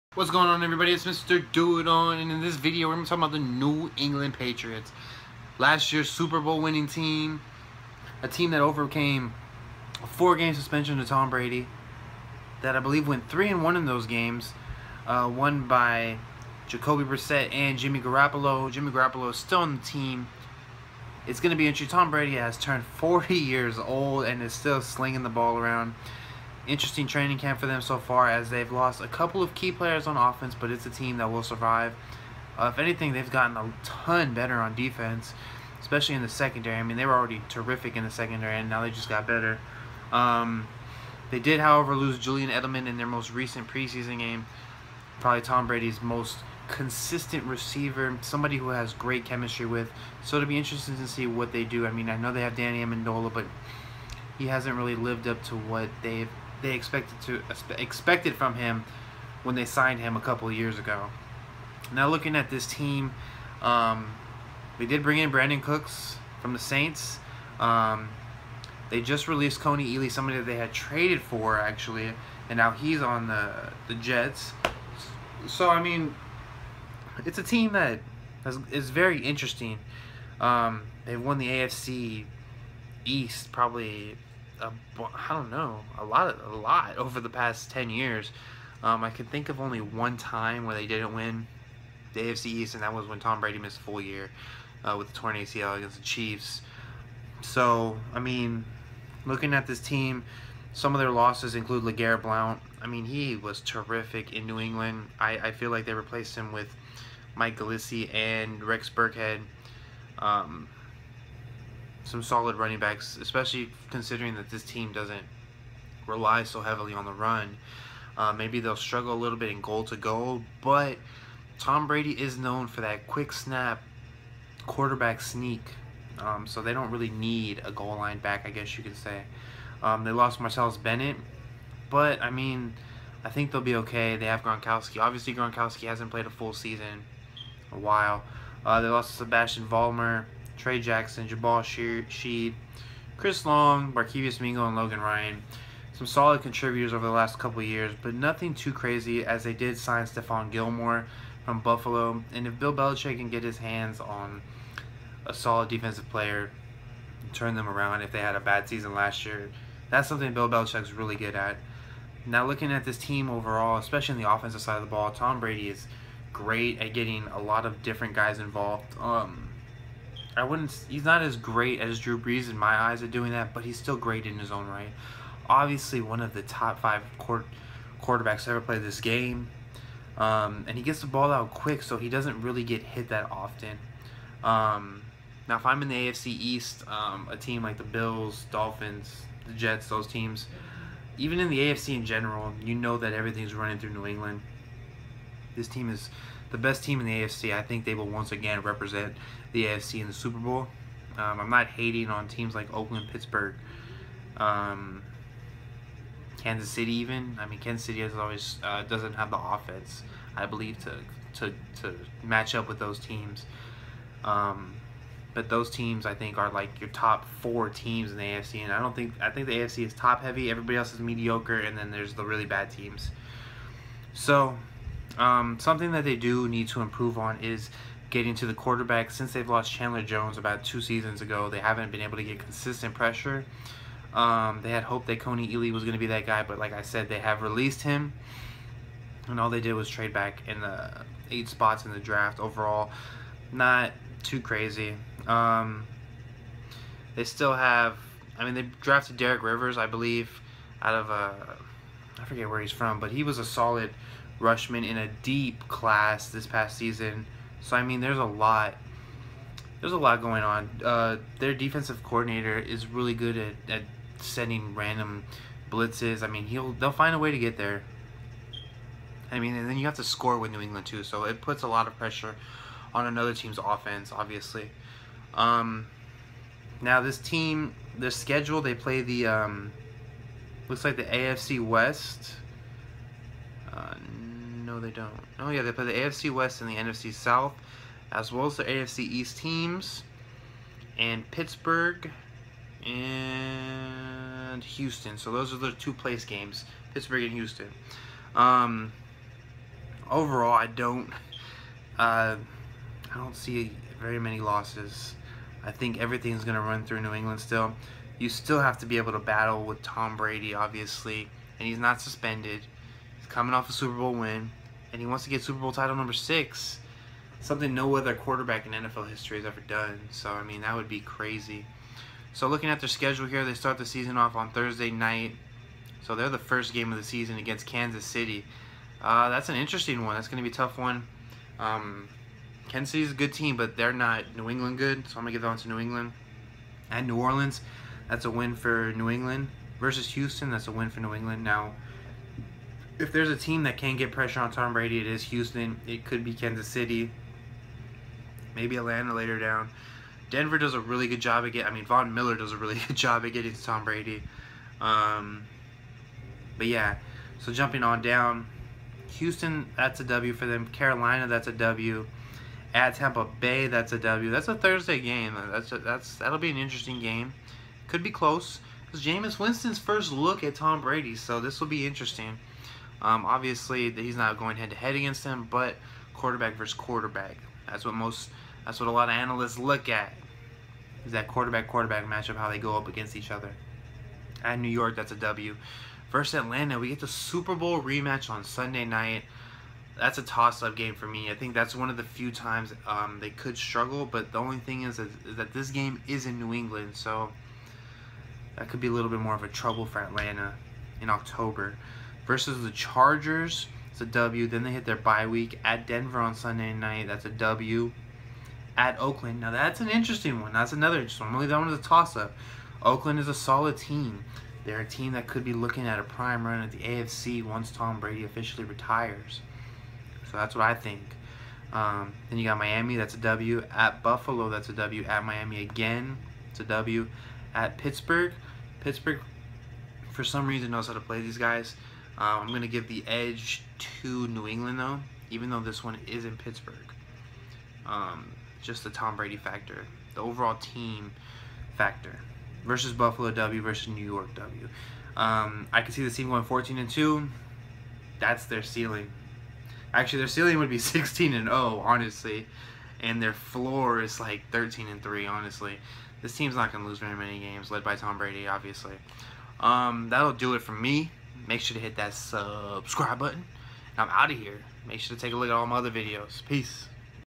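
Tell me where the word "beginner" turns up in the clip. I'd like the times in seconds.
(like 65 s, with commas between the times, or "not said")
not said.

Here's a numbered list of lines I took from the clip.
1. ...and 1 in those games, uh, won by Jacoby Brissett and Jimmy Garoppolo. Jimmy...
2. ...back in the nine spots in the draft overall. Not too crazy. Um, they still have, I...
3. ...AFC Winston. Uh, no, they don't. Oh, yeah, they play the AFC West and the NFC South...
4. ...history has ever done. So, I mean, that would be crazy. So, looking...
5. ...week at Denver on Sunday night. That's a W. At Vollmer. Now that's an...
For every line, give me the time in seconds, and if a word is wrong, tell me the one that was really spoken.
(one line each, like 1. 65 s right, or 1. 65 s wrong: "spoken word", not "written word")
1. 13 s right
2. 240 s wrong: "eight", not "nine"
3. 281 s wrong: "West", not "Winston"
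4. 319 s right
5. 405 s wrong: "Oakland", not "Vollmer".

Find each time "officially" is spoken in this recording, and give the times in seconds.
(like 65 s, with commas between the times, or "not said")
418 s.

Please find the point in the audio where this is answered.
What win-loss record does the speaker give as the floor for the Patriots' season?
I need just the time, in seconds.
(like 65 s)
454 s.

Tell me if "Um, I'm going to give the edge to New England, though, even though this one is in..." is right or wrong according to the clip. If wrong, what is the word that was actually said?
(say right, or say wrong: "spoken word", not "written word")
right.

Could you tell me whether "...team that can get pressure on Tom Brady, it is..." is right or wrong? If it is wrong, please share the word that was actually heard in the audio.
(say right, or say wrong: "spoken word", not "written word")
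right.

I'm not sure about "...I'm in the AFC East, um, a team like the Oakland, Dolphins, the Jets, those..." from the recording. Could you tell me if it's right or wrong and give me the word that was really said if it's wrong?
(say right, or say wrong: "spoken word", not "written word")
wrong: "Bills", not "Oakland".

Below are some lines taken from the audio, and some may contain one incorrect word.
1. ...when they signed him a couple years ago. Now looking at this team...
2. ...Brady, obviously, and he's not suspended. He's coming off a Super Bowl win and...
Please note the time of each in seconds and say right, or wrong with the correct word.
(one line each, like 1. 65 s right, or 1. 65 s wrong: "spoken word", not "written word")
1. 59 s right
2. 310 s right.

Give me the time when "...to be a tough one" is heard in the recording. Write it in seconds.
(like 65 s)
330 s.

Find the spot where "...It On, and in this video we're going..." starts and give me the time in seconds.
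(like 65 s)
1 s.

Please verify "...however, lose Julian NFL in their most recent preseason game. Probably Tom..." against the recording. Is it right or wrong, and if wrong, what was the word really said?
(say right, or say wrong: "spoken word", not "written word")
wrong: "Edelman", not "NFL".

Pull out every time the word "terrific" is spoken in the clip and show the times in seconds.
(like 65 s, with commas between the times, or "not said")
37 s, 103 s.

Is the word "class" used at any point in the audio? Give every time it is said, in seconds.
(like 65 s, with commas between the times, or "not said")
255 s.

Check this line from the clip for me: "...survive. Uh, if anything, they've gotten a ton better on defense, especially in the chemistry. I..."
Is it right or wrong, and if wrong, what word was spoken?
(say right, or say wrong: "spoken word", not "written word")
wrong: "secondary", not "chemistry".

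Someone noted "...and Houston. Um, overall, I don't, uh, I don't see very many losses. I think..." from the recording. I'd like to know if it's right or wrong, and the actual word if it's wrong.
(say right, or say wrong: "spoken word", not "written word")
right.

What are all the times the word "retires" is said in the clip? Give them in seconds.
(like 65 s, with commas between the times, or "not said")
418 s.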